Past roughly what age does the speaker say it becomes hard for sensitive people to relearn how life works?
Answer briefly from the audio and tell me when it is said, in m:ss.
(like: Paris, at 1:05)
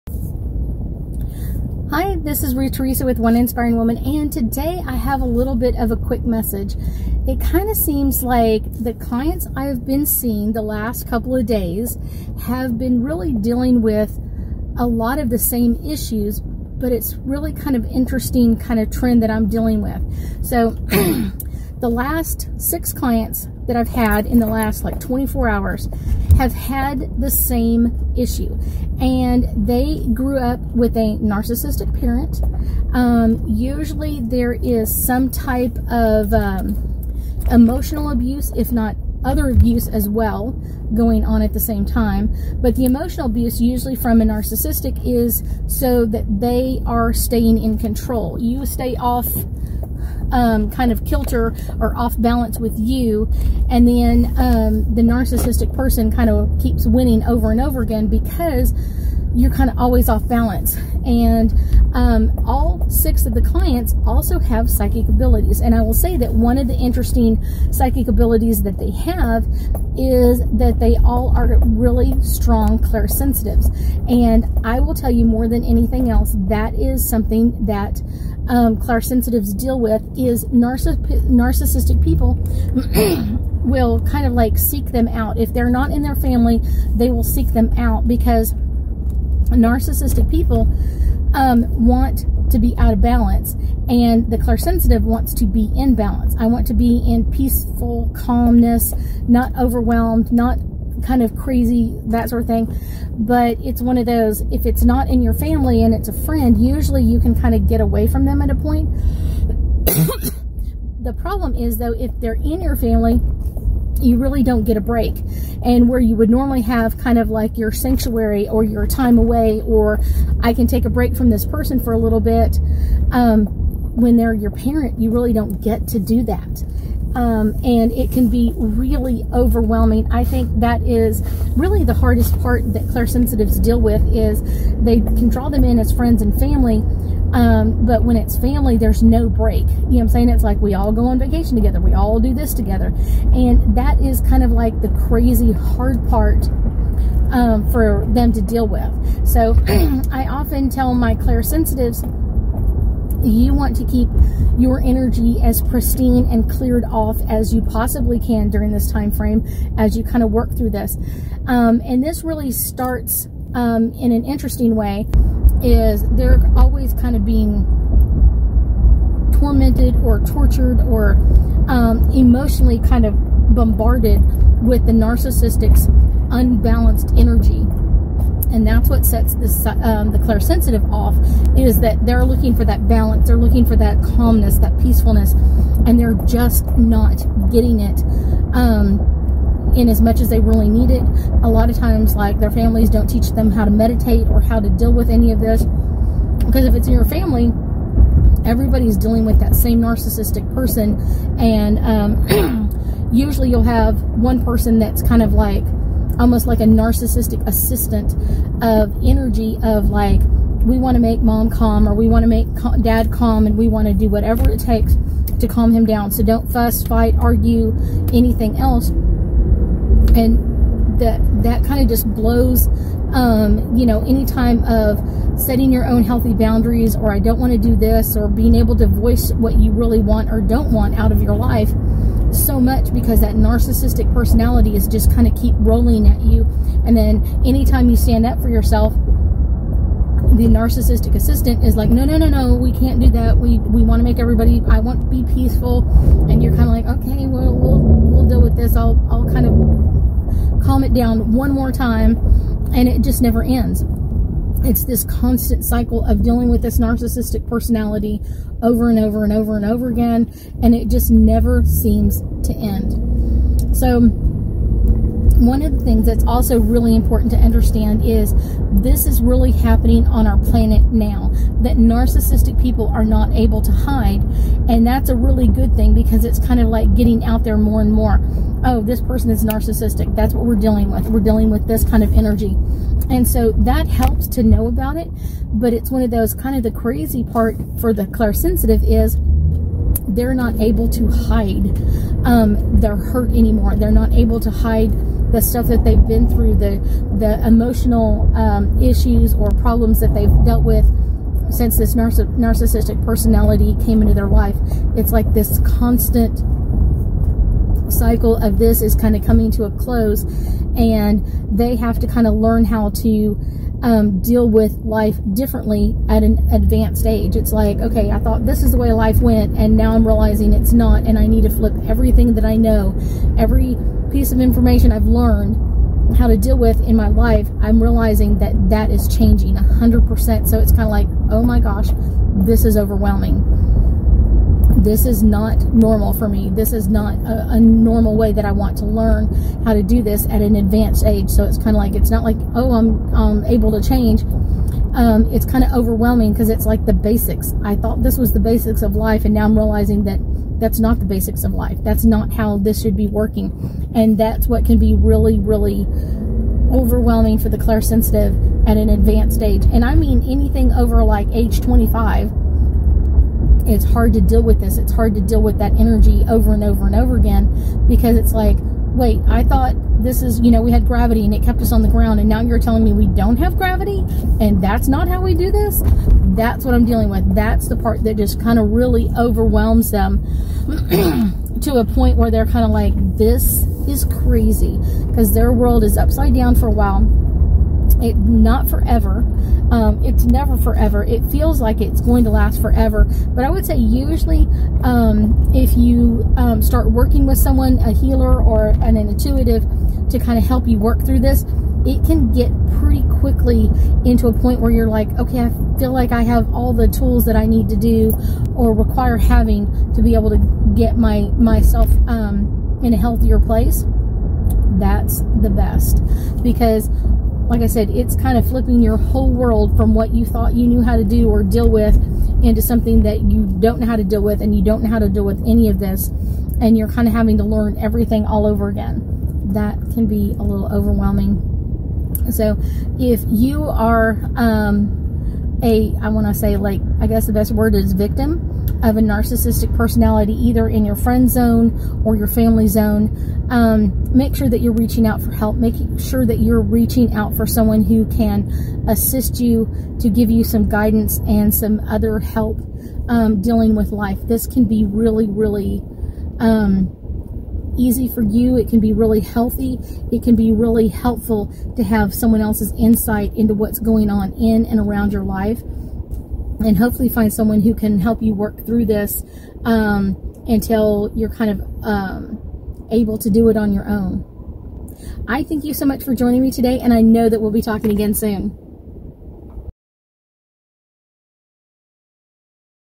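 25, at 6:01.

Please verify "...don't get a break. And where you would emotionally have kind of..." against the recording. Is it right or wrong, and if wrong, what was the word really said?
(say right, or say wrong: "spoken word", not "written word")
wrong: "normally", not "emotionally".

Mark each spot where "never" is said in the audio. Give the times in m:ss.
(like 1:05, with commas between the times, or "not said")
4:13, 4:21, 6:30.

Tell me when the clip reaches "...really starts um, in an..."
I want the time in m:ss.
2:42.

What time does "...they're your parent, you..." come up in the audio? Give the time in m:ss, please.
2:04.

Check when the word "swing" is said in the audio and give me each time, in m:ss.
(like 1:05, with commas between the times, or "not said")
not said.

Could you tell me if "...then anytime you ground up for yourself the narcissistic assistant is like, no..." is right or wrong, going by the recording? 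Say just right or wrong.
wrong.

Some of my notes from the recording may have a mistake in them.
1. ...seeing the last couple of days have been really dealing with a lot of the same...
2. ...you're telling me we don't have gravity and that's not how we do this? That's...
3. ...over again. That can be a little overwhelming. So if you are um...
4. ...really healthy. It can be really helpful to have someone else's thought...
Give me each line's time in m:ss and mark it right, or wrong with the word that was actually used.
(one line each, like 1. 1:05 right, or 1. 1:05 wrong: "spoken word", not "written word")
1. 0:10 right
2. 6:12 right
3. 7:08 right
4. 7:38 wrong: "insight", not "thought".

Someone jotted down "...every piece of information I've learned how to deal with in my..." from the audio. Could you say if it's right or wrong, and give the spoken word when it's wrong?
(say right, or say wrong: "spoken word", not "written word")
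right.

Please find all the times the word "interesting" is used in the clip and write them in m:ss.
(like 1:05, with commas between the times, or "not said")
0:17, 1:06, 2:44.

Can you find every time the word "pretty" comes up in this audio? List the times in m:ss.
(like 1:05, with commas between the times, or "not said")
6:42.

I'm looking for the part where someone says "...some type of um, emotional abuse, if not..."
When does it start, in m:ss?
0:35.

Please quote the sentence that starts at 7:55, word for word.
I thank you so much for joining me today, and I know that we'll be talking again soon.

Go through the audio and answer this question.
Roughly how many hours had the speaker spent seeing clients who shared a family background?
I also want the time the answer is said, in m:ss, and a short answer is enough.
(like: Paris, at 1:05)
24, at 0:24.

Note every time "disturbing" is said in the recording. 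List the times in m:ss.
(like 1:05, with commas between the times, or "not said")
not said.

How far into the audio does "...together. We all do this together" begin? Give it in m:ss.
2:21.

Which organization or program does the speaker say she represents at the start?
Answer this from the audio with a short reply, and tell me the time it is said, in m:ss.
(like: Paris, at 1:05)
One Inspiring Woman, at 0:03.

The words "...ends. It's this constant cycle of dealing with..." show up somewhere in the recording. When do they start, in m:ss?
4:13.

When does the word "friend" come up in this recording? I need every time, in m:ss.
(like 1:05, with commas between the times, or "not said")
1:46, 2:15, 7:20.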